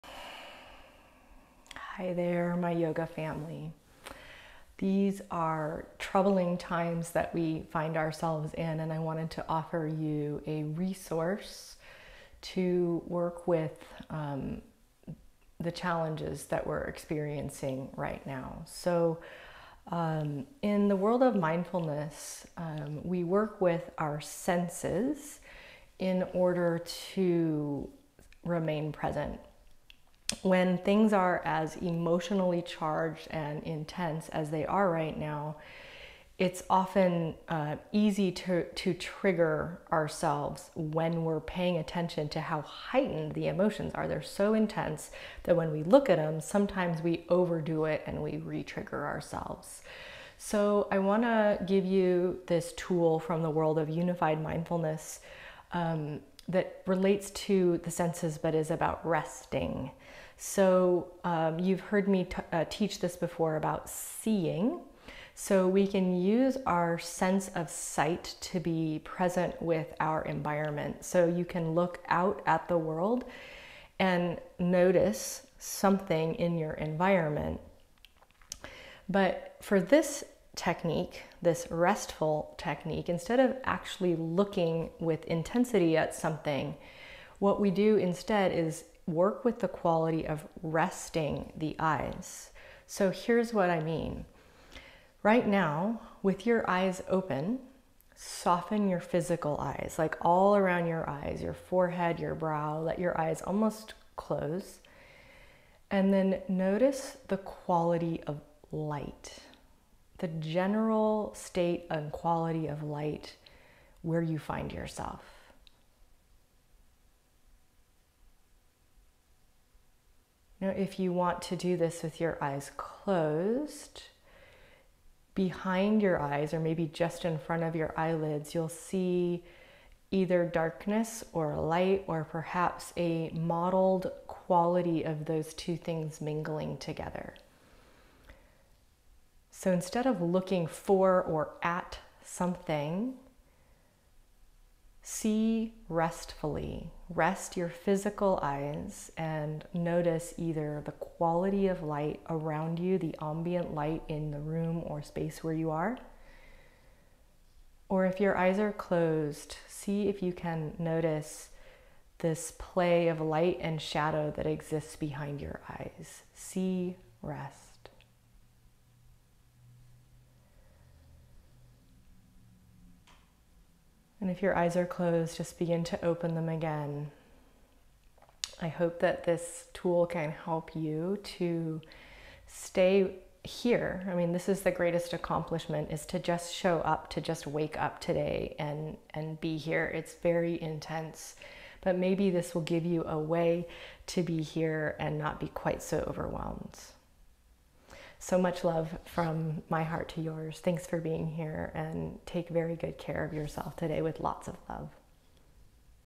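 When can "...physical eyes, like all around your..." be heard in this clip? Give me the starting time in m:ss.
1:38.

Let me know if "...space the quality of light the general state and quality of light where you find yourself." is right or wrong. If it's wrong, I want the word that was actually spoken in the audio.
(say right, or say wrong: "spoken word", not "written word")
wrong: "notice", not "space".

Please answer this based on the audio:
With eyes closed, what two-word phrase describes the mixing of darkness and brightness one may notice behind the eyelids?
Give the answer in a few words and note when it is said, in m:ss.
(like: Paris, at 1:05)
Mottled quality, at 2:13.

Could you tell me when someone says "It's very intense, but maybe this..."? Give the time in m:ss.
3:09.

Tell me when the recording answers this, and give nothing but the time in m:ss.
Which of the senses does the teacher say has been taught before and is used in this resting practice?
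1:07.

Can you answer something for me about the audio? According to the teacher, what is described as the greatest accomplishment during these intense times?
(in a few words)
To just show up.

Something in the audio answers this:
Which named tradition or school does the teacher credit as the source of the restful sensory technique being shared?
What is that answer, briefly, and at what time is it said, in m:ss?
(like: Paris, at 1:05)
Unified mindfulness, at 0:53.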